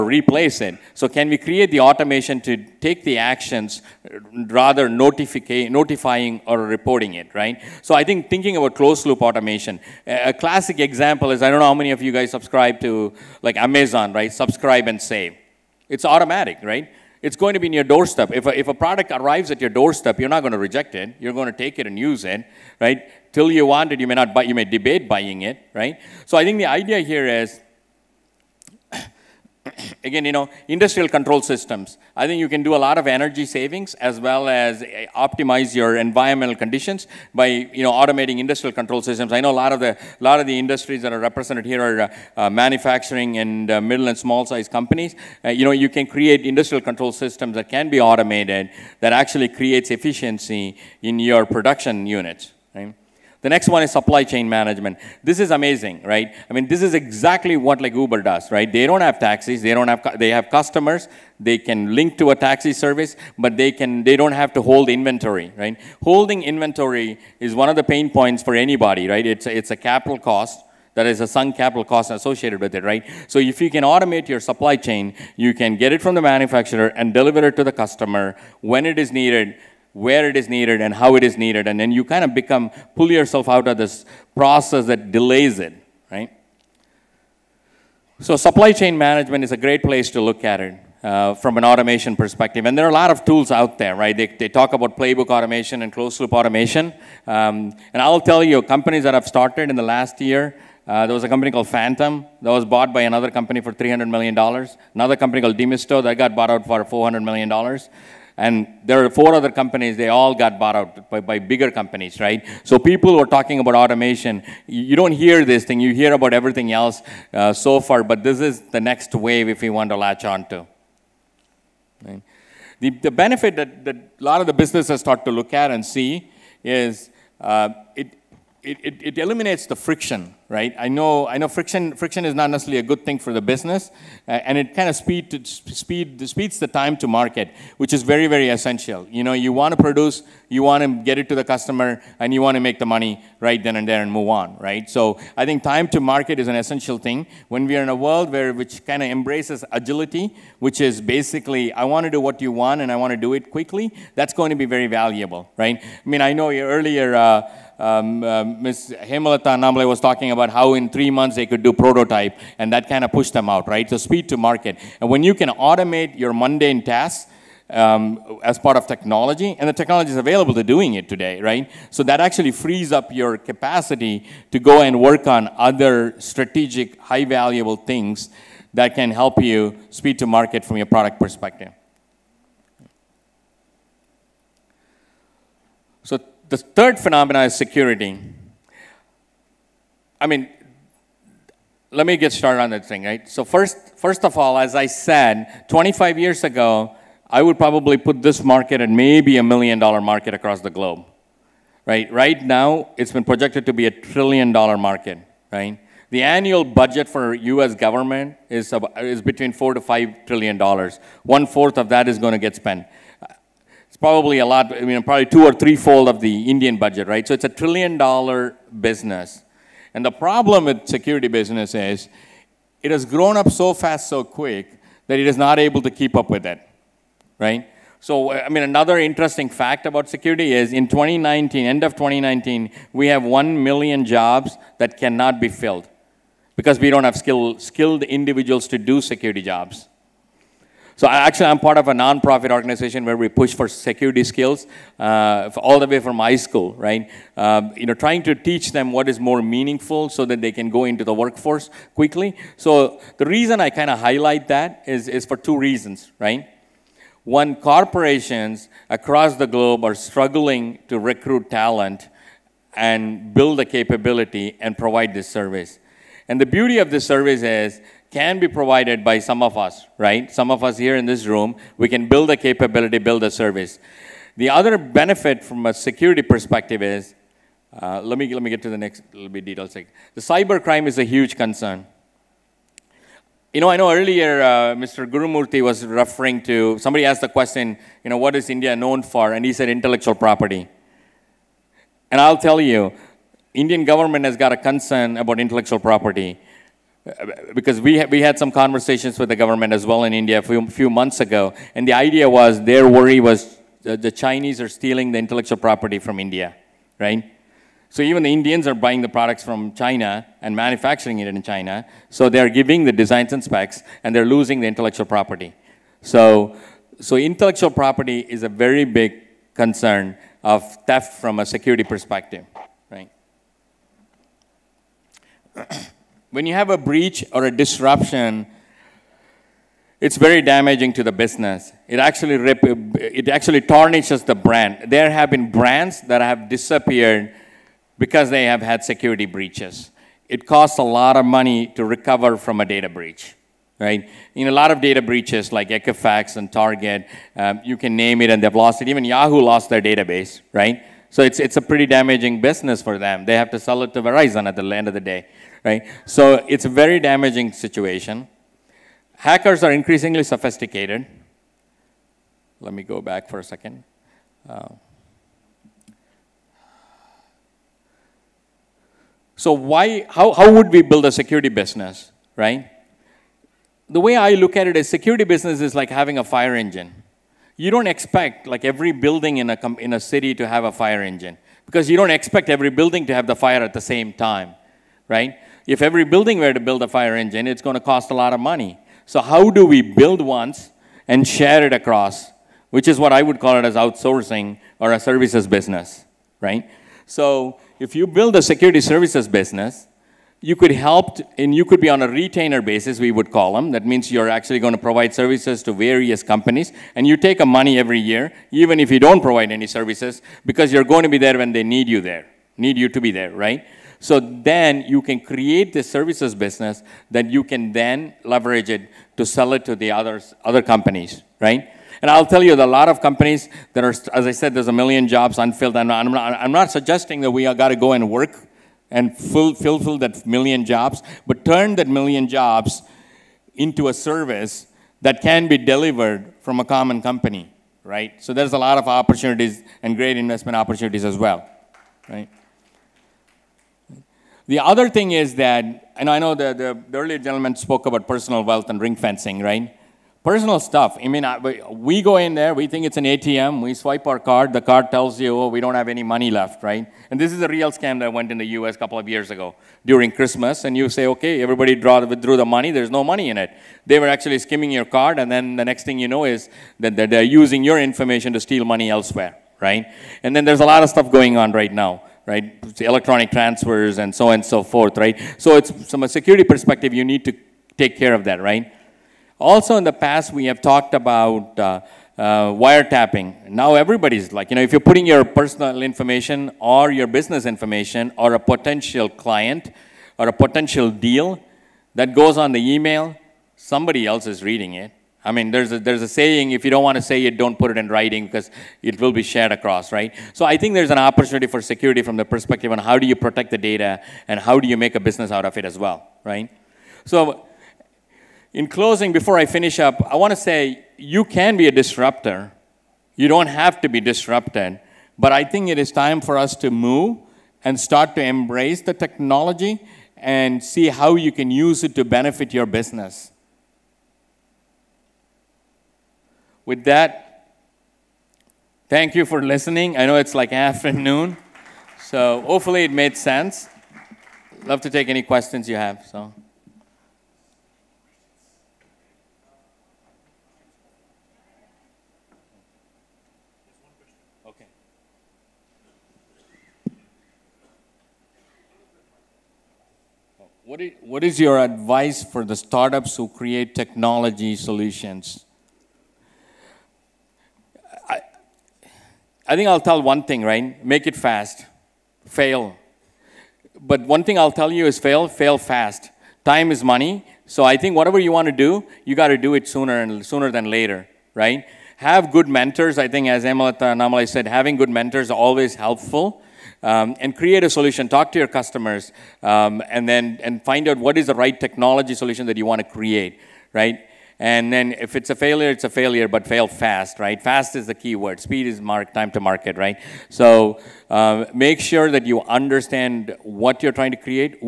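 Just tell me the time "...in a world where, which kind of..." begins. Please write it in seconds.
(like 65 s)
147 s.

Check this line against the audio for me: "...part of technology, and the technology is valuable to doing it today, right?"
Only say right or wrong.
wrong.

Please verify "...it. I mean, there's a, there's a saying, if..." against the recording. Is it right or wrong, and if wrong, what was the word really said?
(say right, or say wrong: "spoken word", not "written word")
right.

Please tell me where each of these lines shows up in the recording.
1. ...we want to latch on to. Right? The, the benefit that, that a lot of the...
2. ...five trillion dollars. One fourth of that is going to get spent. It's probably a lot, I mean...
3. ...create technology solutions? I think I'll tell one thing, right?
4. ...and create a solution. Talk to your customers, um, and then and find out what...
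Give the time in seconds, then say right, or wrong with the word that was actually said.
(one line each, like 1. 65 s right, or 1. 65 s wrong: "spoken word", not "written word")
1. 119 s right
2. 209 s right
3. 553 s right
4. 577 s right.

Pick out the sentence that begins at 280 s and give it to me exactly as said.
The cyber crime is a huge concern.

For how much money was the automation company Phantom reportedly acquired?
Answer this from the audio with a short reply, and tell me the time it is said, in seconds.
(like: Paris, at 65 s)
$300 million, at 103 s.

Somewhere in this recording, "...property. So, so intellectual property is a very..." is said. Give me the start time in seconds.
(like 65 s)
315 s.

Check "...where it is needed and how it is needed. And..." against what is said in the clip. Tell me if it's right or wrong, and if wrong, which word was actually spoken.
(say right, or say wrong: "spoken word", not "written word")
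right.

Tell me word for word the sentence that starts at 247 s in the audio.
Um, you know, trying to teach them what is more meaningful so that they can go into the workforce quickly.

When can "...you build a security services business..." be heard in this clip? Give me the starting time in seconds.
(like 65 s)
397 s.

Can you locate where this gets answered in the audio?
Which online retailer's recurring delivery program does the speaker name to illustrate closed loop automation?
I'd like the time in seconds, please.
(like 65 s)
14 s.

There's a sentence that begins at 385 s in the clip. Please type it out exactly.
If every building were to build a fire engine, it's going to cost a lot of money.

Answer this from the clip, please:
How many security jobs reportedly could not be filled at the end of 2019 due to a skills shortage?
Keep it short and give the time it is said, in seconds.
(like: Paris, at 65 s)
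1 million, at 233 s.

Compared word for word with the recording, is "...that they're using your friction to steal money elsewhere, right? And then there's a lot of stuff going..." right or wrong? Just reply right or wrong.
wrong.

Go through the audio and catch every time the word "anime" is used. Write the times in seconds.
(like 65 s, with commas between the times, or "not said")
not said.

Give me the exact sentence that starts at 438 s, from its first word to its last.
So there's a lot of opportunities and great investment opportunities as well, right?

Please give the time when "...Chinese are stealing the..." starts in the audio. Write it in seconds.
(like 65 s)
304 s.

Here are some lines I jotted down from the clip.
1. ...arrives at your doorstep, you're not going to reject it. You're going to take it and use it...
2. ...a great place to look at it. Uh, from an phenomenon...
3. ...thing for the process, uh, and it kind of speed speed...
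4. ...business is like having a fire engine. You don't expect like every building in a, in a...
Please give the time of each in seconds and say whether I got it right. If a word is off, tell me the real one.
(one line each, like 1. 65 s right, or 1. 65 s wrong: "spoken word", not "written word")
1. 19 s right
2. 89 s wrong: "automation", not "phenomenon"
3. 133 s wrong: "business", not "process"
4. 375 s right.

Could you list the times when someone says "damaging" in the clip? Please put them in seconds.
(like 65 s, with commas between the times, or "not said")
330 s, 351 s, 357 s.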